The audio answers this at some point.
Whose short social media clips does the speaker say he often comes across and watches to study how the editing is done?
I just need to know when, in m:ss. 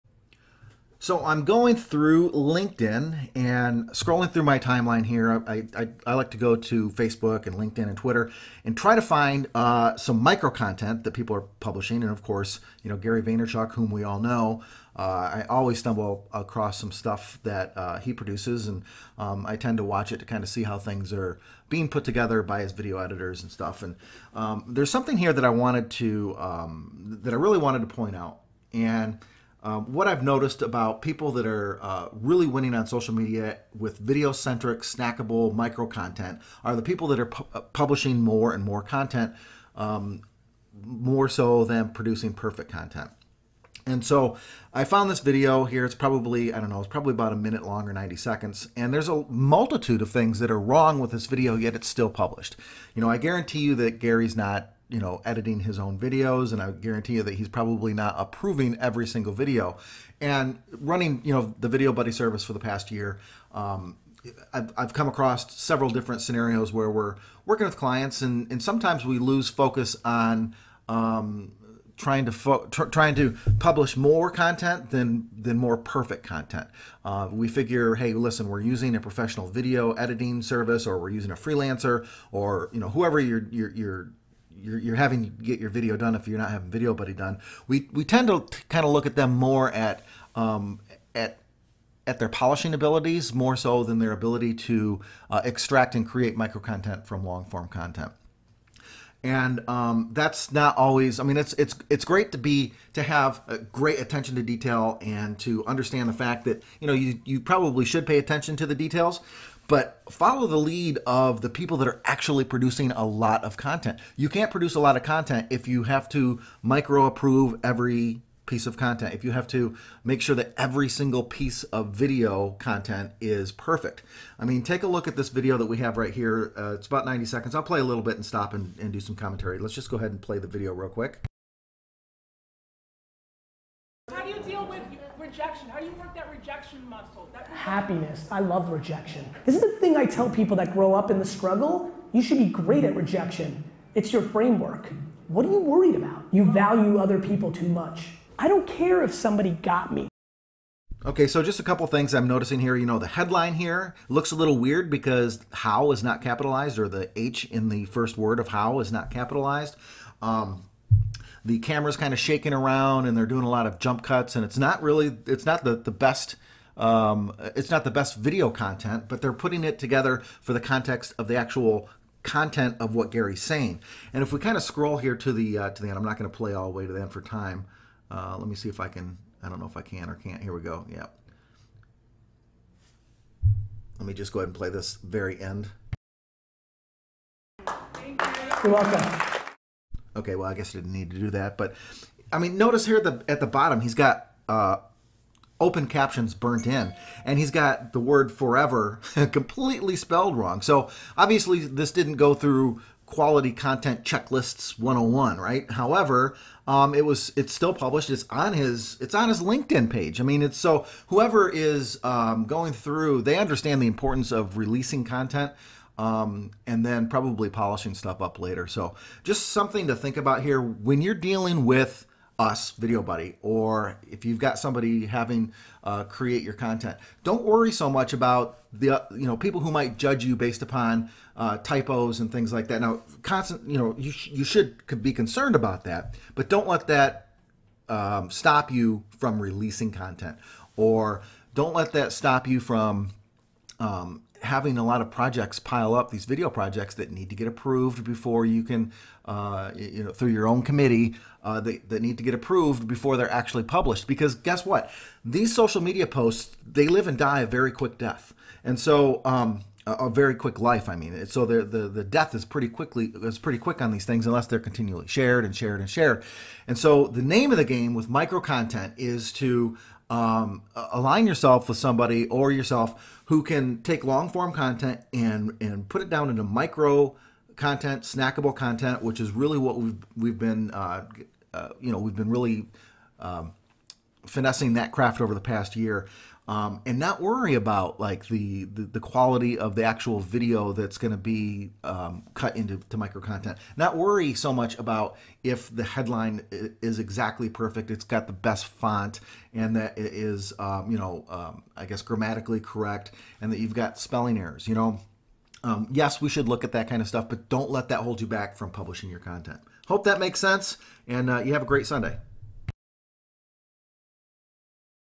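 0:12.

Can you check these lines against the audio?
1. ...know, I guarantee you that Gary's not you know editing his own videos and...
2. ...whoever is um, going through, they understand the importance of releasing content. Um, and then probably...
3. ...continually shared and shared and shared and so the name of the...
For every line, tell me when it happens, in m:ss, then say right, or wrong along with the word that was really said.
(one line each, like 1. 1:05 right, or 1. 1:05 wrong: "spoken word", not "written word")
1. 0:53 right
2. 3:31 right
3. 4:24 right.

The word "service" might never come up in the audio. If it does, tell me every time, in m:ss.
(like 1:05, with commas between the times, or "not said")
1:02, 1:20.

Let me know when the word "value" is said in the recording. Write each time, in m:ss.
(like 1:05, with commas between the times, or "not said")
2:26.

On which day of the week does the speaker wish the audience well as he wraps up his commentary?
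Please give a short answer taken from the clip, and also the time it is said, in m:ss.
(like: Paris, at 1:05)
Sunday, at 5:11.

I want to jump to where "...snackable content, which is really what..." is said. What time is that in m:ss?
4:38.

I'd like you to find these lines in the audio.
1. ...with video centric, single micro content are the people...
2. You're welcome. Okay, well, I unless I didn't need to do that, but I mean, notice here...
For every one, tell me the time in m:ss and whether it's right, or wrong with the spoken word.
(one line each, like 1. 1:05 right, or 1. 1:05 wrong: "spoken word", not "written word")
1. 0:33 wrong: "snackable", not "single"
2. 3:07 wrong: "guess", not "unless".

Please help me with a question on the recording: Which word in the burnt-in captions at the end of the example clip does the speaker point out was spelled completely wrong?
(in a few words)
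forever.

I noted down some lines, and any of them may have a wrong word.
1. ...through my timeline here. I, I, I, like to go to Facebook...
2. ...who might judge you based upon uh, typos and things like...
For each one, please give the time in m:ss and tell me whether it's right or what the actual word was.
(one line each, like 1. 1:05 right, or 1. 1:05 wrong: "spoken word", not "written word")
1. 0:04 right
2. 3:49 right.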